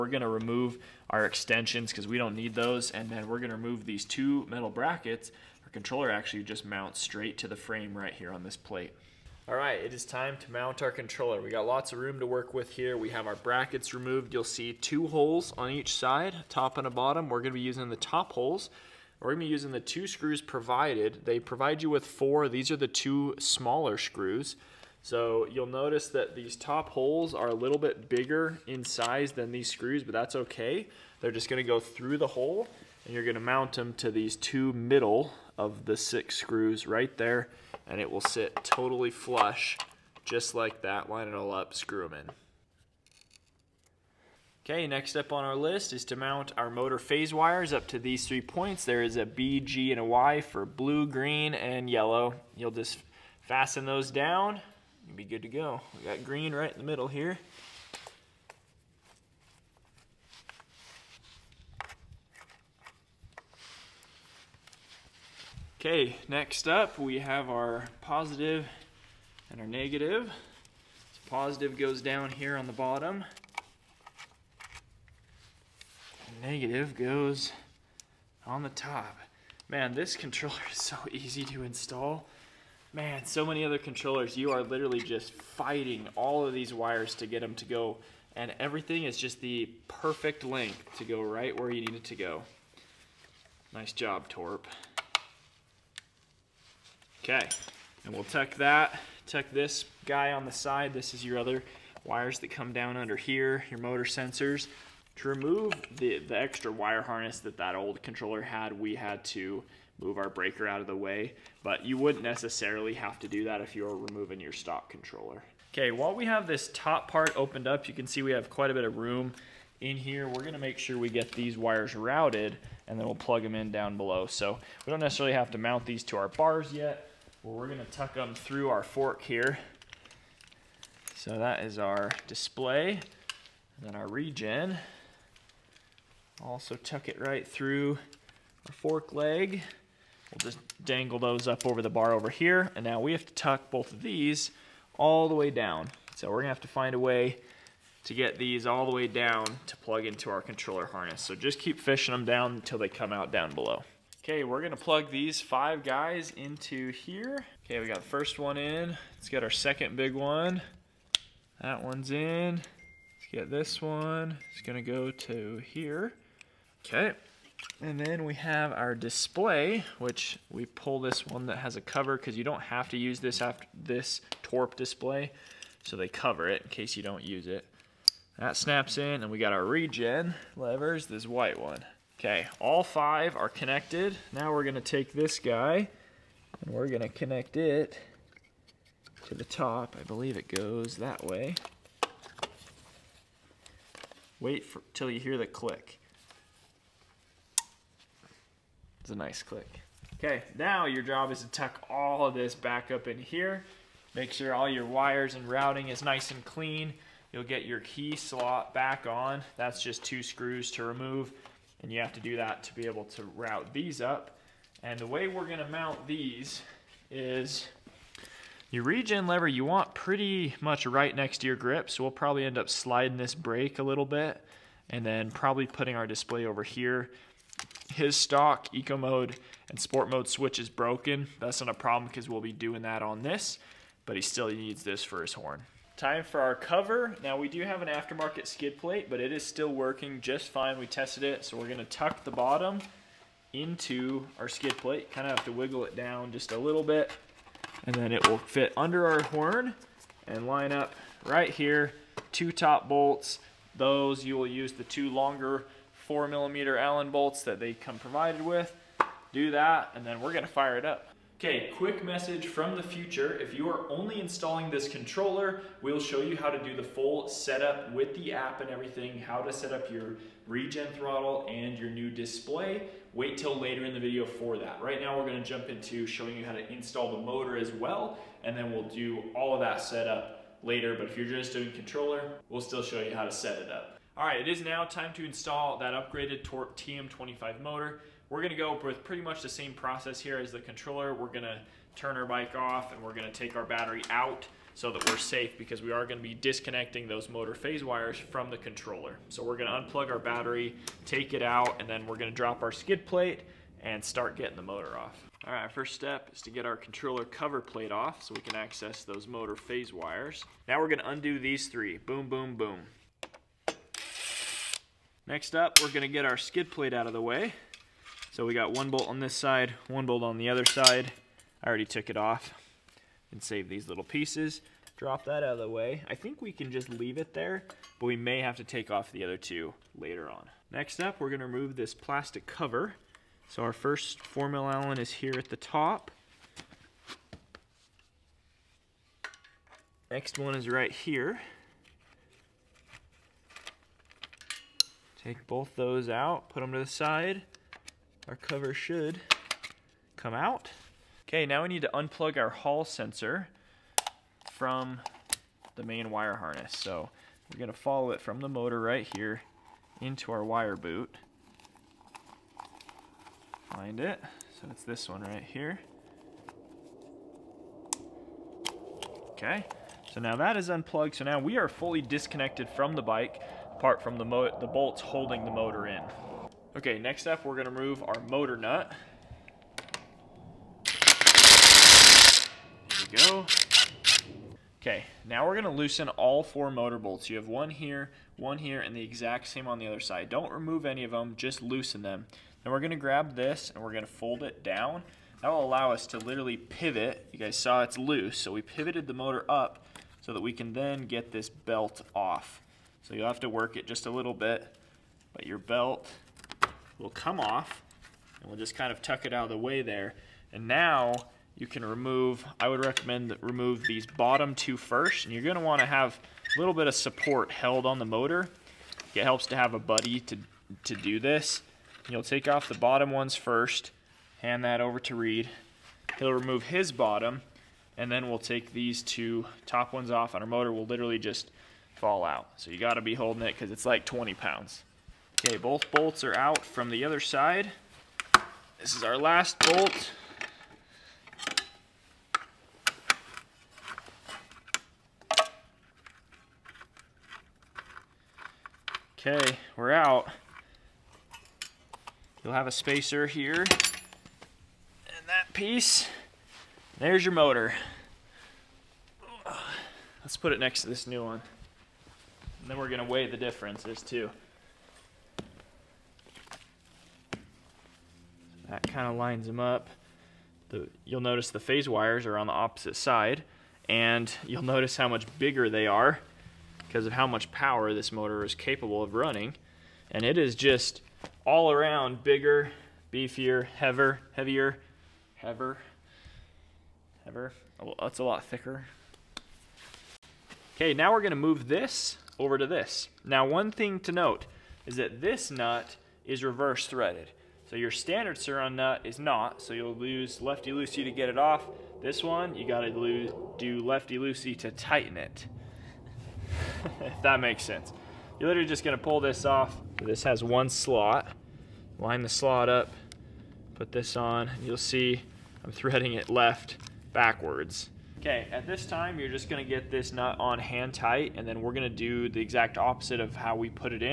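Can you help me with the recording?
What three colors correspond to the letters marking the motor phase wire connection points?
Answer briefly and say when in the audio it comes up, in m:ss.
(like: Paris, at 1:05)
Blue, green, and yellow, at 0:50.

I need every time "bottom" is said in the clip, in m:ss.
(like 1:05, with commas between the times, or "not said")
0:16, 1:12, 4:02, 6:54, 7:02, 7:06.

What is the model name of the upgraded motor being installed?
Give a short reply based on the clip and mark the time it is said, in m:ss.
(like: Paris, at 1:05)
TM25, at 4:46.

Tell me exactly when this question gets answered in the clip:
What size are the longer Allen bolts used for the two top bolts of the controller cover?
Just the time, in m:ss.
4:15.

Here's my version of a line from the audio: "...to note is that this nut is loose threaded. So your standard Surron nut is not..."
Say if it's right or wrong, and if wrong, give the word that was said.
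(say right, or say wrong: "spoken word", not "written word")
wrong: "reverse", not "loose".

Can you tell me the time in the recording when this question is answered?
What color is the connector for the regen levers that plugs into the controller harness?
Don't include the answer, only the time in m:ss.
3:01.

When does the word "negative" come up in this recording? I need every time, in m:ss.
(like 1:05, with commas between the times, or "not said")
1:09, 1:16.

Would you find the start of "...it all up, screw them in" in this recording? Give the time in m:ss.
0:41.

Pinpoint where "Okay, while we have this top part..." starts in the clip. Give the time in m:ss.
1:55.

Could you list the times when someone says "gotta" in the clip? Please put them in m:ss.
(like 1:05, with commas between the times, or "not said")
7:12, 8:22.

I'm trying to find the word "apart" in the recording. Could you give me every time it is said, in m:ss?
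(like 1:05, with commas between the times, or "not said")
6:13.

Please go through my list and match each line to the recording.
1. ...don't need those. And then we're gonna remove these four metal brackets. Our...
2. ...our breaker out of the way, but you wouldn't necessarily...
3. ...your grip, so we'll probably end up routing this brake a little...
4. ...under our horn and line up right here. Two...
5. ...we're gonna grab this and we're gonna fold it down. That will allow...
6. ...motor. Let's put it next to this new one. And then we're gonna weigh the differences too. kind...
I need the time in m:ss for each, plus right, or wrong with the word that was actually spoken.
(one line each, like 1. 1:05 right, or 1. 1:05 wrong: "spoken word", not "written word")
1. 0:02 wrong: "two", not "four"
2. 1:50 right
3. 3:41 wrong: "sliding", not "routing"
4. 4:08 right
5. 6:32 right
6. 7:37 right.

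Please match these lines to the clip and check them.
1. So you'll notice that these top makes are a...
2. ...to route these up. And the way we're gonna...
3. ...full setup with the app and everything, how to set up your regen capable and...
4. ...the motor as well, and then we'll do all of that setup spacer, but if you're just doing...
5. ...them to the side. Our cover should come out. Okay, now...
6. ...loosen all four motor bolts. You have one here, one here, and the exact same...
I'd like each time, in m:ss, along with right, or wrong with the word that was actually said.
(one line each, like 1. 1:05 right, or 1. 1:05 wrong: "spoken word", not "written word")
1. 0:25 wrong: "holes", not "makes"
2. 3:33 right
3. 4:26 wrong: "throttle", not "capable"
4. 4:37 wrong: "later", not "spacer"
5. 5:46 right
6. 6:25 right.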